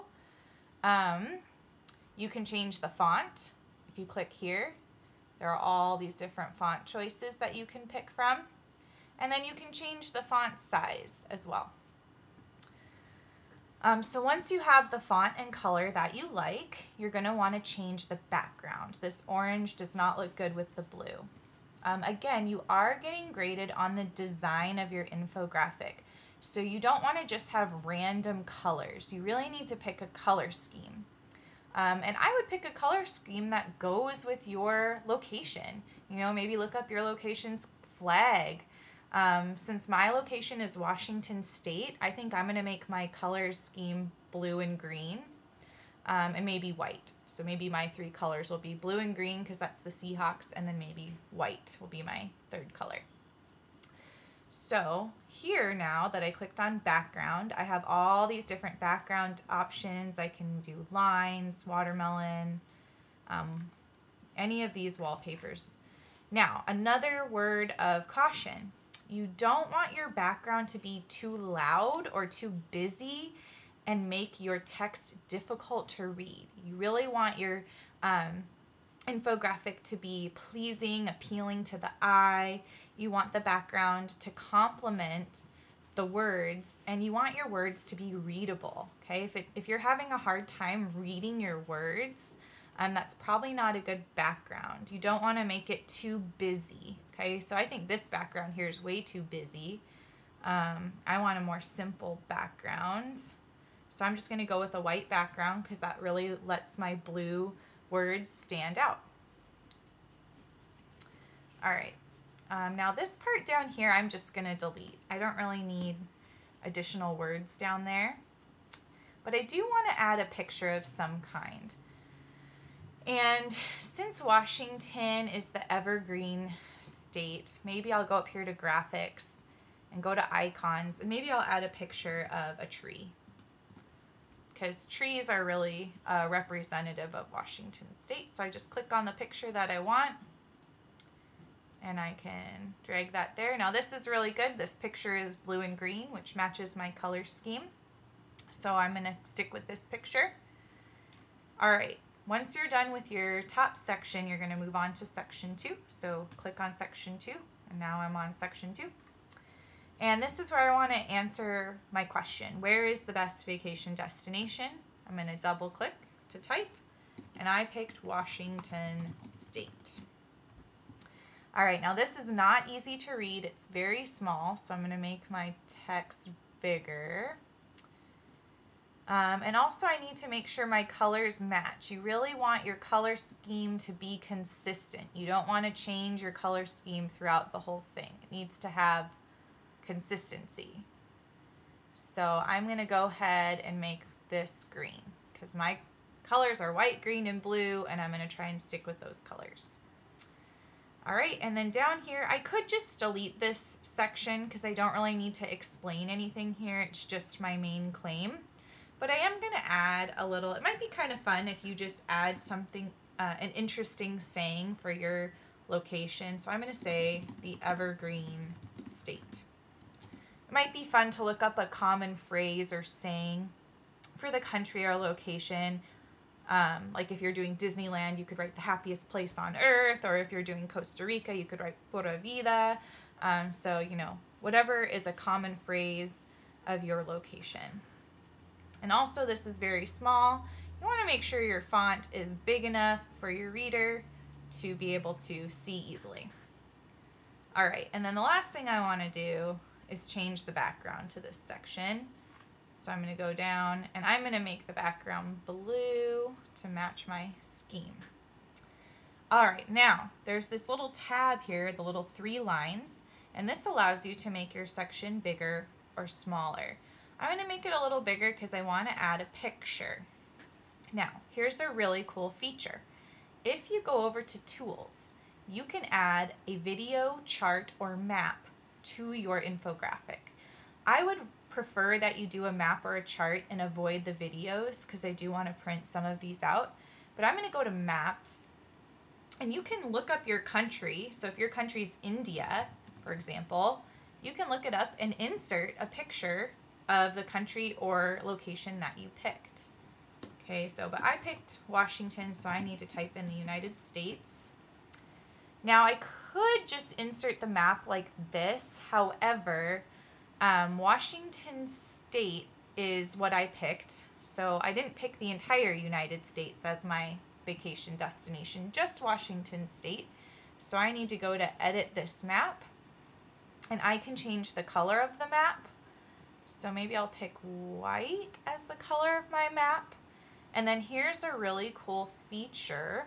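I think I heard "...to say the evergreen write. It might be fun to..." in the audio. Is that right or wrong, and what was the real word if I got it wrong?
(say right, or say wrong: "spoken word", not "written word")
wrong: "state", not "write".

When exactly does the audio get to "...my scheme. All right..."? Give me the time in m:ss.
4:17.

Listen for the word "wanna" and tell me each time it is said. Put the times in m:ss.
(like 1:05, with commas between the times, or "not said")
1:59, 4:00, 4:08.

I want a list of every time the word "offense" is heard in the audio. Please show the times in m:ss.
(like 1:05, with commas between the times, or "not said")
not said.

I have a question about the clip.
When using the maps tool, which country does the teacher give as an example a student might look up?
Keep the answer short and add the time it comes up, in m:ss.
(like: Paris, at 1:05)
India, at 4:52.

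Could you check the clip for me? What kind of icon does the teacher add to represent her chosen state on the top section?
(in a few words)
A tree.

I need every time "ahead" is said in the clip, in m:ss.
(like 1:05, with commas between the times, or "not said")
3:13.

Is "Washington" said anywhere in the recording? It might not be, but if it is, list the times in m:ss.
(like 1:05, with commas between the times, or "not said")
0:40, 2:04, 2:17, 2:48, 5:01, 5:10, 5:19.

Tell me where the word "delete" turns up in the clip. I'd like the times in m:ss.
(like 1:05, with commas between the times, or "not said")
1:54, 3:23.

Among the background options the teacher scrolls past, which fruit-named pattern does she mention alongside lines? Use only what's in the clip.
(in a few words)
Watermelon.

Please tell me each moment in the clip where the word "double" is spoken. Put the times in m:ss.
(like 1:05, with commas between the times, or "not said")
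2:45.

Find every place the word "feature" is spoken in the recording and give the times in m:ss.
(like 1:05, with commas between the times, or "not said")
4:32, 5:32.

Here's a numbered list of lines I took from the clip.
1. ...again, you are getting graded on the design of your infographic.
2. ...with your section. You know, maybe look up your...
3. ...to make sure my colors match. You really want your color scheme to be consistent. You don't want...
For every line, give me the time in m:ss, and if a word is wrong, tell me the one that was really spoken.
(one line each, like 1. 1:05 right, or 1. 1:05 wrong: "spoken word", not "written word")
1. 0:22 right
2. 0:34 wrong: "location", not "section"
3. 3:00 right.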